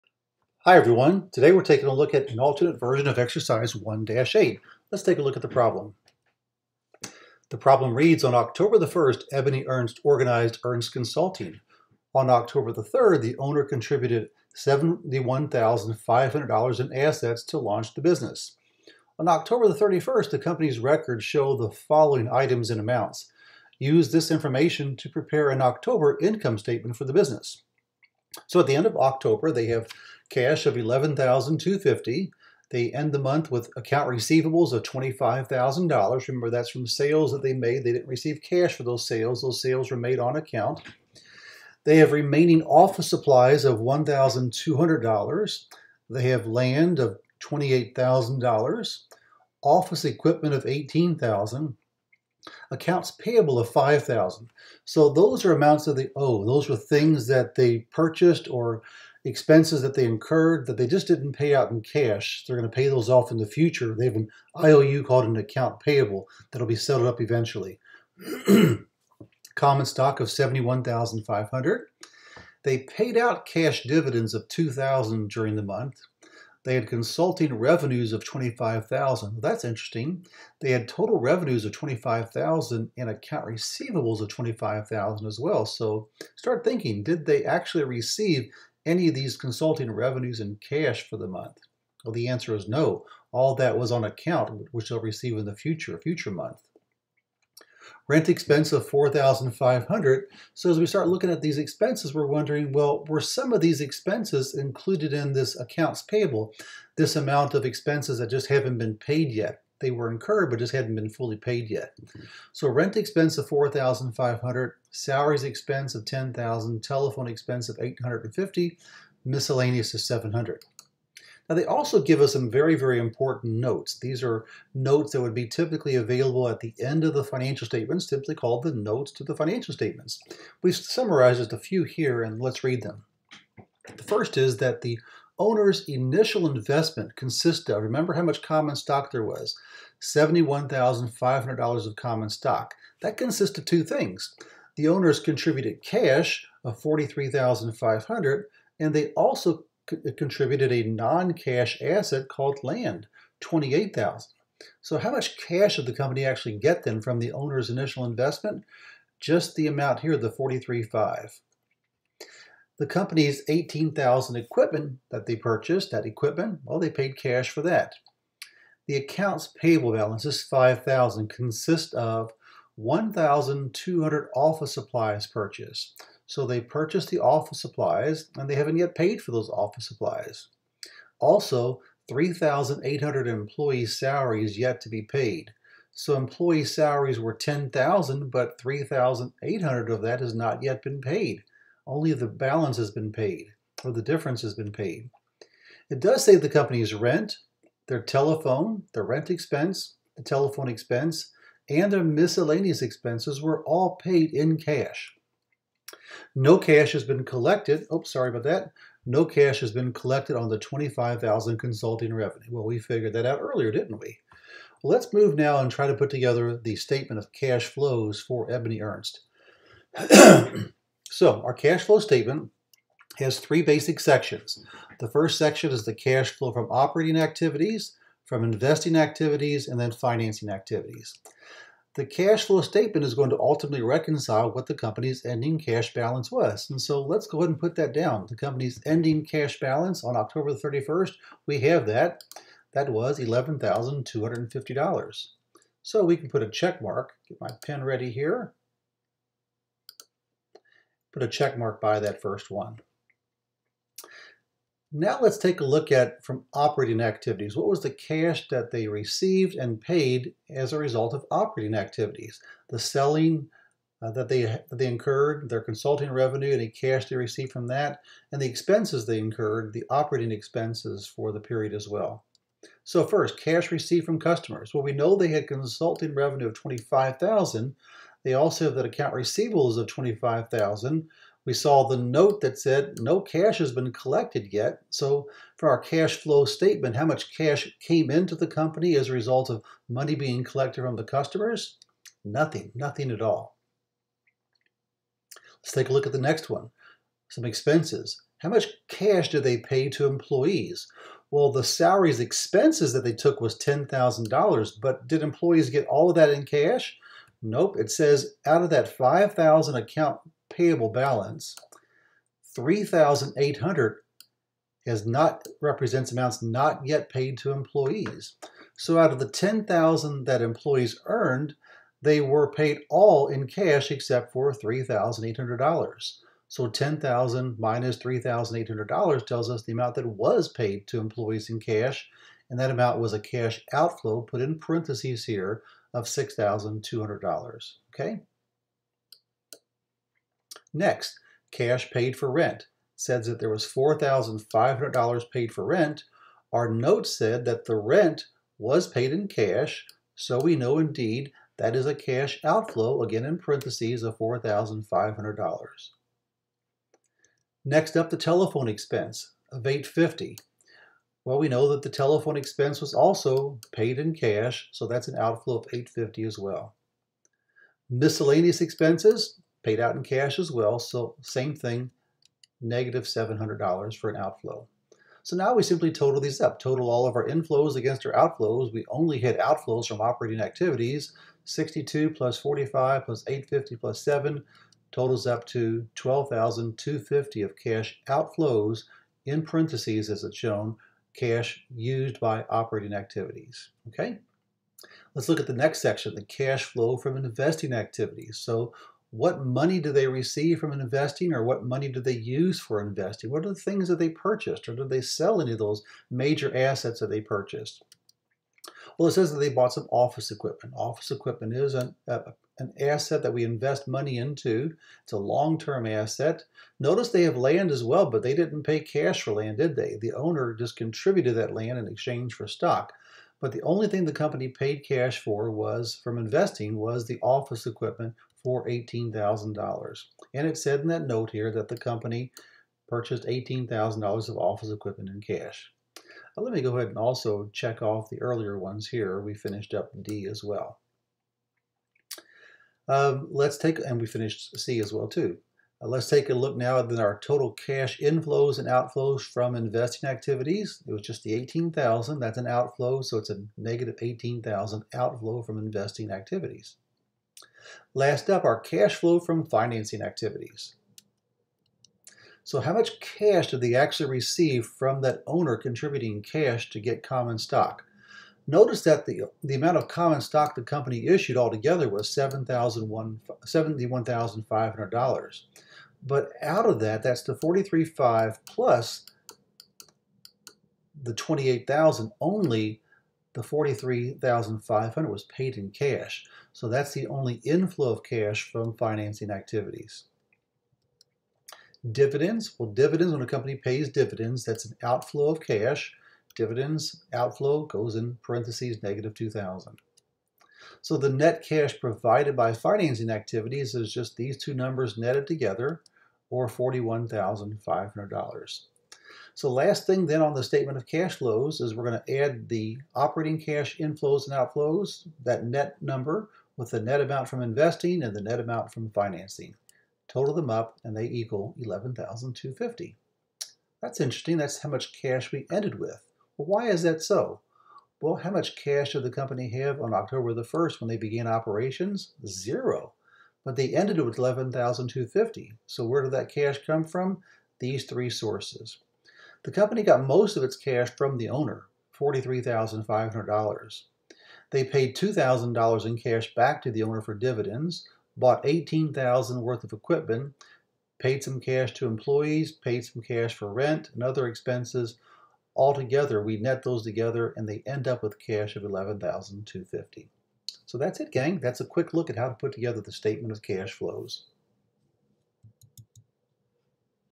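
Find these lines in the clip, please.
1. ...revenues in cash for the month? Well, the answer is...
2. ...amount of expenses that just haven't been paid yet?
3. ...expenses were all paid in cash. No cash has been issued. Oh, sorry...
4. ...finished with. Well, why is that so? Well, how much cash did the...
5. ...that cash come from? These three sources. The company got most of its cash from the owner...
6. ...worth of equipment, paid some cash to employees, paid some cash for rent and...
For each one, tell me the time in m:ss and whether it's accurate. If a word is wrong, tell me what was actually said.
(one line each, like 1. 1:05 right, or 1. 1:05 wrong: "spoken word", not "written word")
1. 1:29 right
2. 1:47 right
3. 3:22 wrong: "collected", not "issued"
4. 8:45 wrong: "ended", not "finished"
5. 8:56 right
6. 9:09 right.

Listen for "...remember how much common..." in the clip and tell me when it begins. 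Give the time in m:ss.
2:17.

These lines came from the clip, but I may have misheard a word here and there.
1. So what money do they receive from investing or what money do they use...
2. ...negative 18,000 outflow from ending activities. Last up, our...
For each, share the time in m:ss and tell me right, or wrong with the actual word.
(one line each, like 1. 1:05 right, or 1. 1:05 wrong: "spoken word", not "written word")
1. 6:38 right
2. 7:33 wrong: "investing", not "ending".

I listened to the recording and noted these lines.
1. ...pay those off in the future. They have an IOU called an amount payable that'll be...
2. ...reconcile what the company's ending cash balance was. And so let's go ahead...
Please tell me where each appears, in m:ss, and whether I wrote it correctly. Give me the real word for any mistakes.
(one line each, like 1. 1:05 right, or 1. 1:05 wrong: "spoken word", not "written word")
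1. 1:02 wrong: "account", not "amount"
2. 3:53 right.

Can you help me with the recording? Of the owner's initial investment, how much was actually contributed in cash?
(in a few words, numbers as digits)
$43,500.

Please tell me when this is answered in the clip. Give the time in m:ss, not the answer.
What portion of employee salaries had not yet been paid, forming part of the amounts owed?
3:02.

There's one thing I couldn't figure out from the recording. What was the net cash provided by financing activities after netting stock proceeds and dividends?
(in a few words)
$41,500.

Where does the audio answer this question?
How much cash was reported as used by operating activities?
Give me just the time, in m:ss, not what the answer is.
6:24.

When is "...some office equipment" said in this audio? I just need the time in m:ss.
6:49.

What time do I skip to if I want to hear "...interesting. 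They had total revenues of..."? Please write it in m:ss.
1:19.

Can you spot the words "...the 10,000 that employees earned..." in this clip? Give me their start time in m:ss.
5:19.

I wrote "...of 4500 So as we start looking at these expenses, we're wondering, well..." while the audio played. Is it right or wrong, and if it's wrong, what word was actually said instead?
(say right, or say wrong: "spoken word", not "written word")
right.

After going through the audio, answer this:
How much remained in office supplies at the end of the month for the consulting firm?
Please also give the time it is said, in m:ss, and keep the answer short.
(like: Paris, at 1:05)
$1,200, at 0:42.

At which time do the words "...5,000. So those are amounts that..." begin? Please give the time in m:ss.
0:53.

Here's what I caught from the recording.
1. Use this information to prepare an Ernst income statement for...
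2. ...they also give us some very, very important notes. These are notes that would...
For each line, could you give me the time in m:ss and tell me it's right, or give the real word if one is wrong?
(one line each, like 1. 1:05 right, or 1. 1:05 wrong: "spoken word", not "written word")
1. 0:23 wrong: "October", not "Ernst"
2. 2:01 right.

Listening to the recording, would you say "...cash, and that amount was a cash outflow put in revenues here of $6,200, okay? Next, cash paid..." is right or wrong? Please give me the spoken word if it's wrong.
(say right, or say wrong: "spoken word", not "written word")
wrong: "parentheses", not "revenues".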